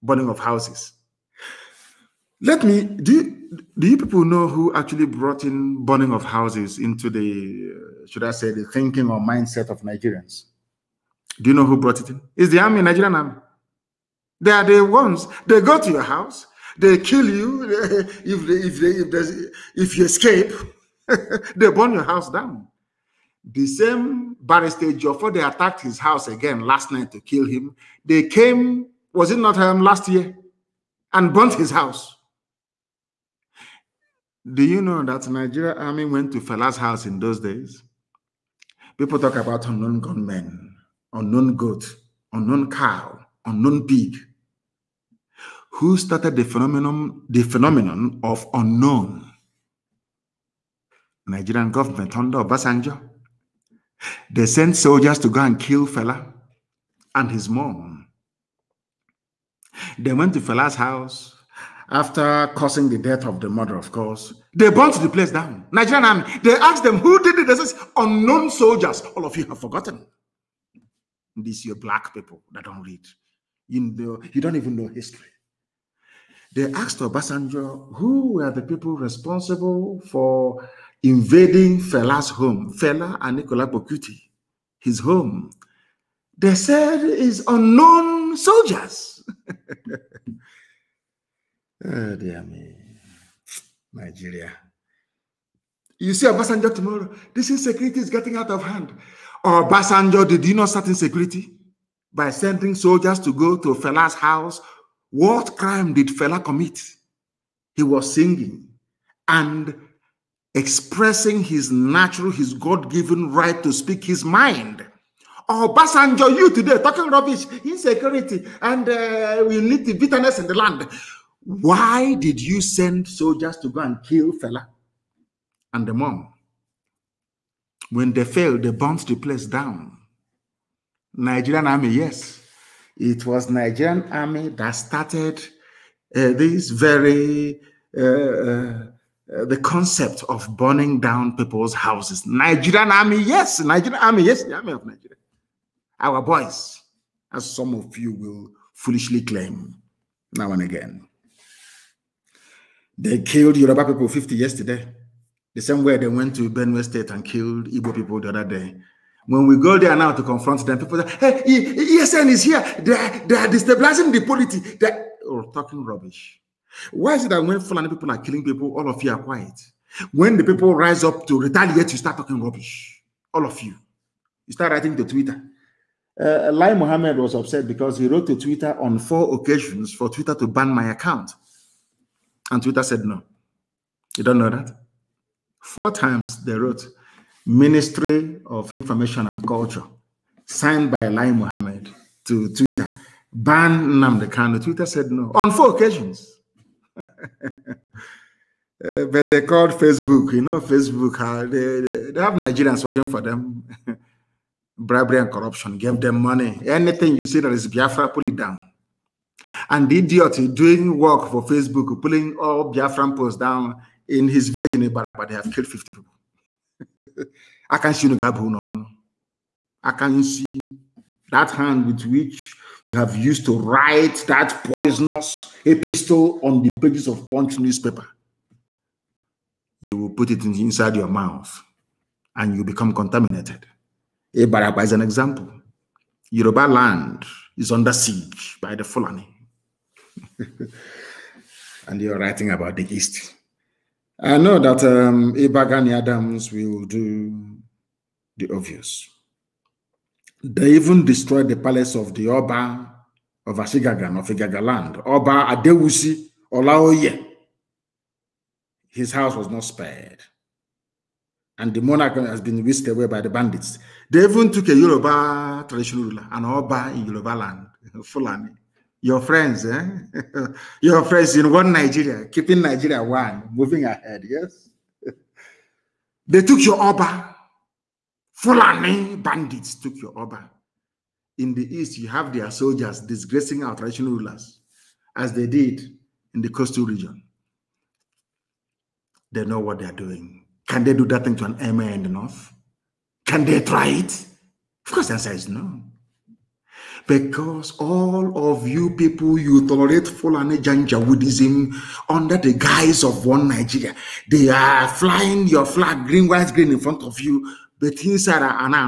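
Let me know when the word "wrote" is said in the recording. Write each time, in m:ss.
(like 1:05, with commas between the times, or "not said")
2:58, 3:06.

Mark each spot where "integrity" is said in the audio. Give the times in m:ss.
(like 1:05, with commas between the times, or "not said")
not said.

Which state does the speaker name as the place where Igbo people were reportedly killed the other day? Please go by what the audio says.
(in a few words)
Benue State.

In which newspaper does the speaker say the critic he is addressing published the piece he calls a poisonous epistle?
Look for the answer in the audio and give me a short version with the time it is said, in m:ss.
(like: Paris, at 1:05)
Punch, at 3:47.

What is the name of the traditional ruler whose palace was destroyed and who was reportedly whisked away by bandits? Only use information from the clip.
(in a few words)
Oba Adewusi Olaoye.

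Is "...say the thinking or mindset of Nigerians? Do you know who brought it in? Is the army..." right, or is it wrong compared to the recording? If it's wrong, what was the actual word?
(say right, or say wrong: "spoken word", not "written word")
right.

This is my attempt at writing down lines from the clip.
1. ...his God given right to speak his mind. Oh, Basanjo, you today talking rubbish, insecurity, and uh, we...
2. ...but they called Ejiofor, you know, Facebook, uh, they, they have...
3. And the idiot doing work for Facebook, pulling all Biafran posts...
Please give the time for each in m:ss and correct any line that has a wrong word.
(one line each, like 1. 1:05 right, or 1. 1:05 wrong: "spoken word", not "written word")
1. 1:52 right
2. 3:19 wrong: "Facebook", not "Ejiofor"
3. 3:29 right.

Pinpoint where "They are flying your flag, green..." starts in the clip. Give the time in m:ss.
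5:04.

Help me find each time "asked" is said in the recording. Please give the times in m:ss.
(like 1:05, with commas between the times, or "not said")
1:06, 1:16.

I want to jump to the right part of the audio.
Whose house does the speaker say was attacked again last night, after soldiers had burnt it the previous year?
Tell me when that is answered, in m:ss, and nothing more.
0:24.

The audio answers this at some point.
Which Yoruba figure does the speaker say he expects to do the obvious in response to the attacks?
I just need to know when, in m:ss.
4:05.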